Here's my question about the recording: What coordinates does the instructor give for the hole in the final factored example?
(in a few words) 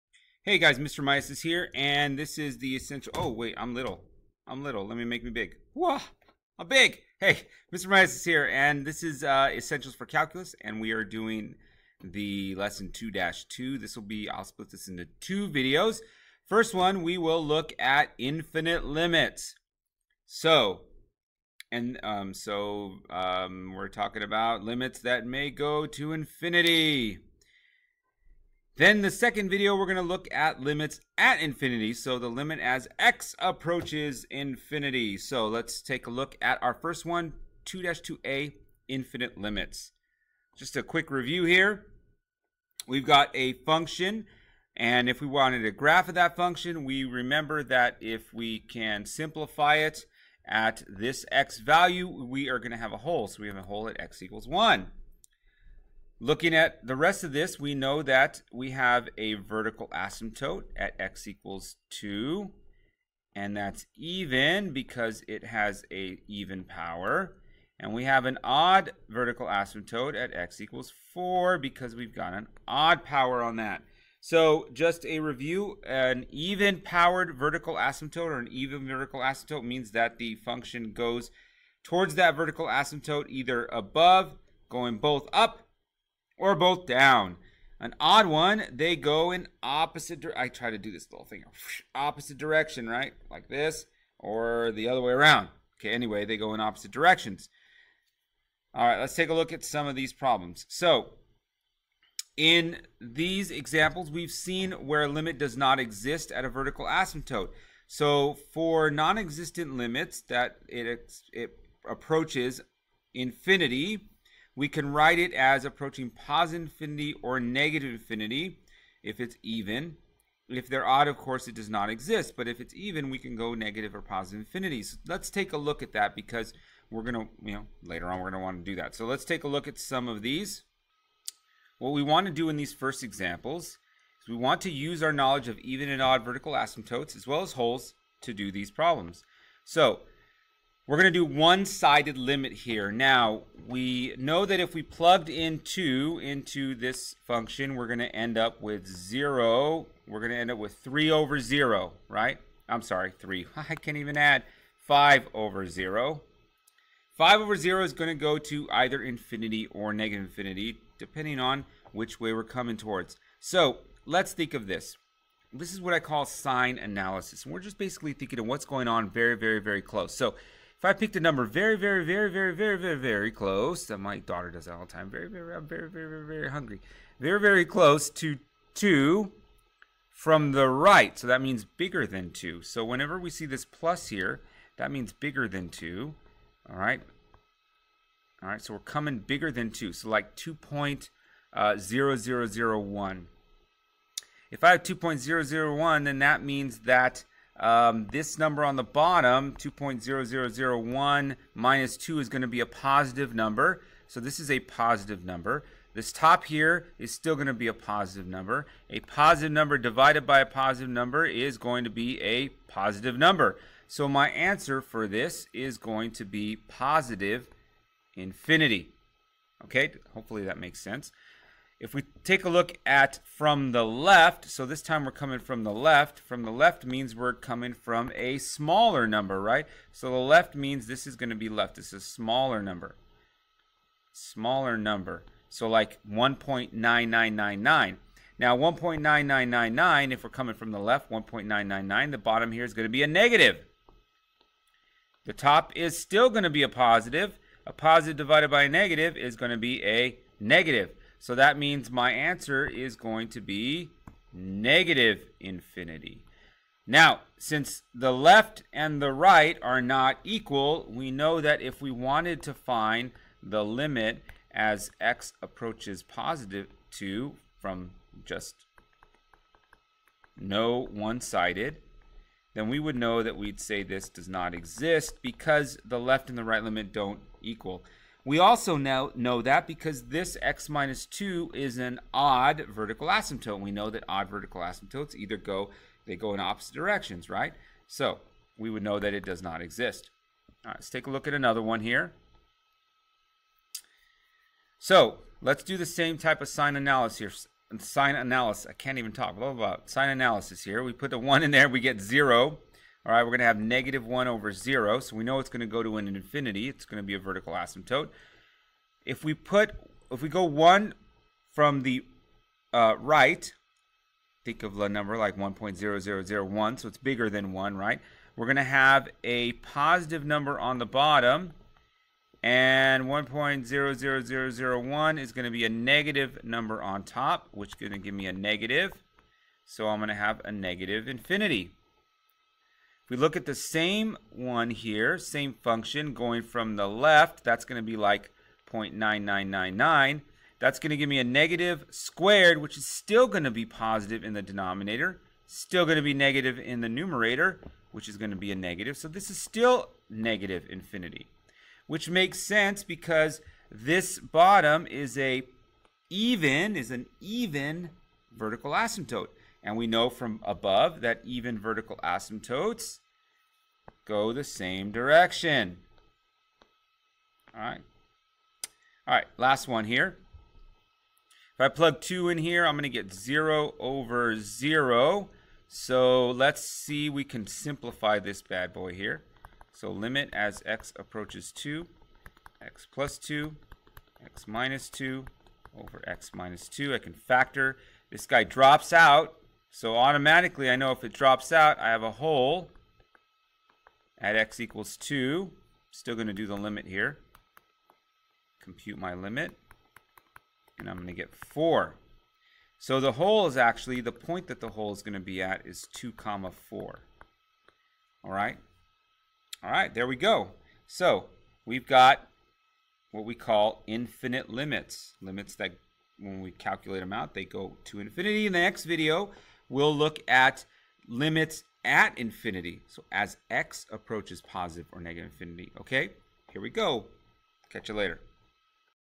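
(2, 4).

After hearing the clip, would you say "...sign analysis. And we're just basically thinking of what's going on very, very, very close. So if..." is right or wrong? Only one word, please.
right.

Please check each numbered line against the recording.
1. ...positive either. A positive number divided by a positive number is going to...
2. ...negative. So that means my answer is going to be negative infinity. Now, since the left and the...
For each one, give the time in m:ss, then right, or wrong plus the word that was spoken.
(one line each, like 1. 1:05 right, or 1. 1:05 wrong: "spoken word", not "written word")
1. 3:27 wrong: "number", not "either"
2. 4:10 right.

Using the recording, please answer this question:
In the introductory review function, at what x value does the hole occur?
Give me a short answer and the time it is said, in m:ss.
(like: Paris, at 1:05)
x equals 1, at 0:53.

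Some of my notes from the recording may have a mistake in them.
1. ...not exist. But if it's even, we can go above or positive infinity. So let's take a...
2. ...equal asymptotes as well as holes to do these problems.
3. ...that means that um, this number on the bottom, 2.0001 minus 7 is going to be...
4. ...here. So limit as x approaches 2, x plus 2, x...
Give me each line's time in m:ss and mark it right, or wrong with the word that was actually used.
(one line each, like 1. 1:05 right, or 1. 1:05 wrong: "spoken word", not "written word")
1. 2:01 wrong: "negative", not "above"
2. 2:16 wrong: "vertical", not "equal"
3. 3:16 wrong: "2", not "7"
4. 6:18 right.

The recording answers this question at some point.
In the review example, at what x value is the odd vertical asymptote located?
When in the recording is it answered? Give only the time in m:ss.
1:10.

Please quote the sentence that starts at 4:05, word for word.
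The top is still going to be a positive.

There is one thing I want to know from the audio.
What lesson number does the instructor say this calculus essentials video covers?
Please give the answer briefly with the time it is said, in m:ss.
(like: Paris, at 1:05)
2-2, at 0:12.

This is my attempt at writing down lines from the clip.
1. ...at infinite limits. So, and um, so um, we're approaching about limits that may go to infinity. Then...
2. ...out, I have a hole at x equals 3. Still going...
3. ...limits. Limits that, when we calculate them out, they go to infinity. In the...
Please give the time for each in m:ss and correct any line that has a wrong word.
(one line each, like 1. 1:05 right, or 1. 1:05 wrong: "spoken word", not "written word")
1. 0:17 wrong: "talking", not "approaching"
2. 6:31 wrong: "2", not "3"
3. 6:54 right.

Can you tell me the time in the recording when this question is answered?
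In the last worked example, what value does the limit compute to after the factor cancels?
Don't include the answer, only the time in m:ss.
6:40.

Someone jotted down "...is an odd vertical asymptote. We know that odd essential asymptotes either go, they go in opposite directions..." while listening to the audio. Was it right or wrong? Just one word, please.
wrong.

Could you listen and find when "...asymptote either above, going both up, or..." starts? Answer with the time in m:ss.
1:22.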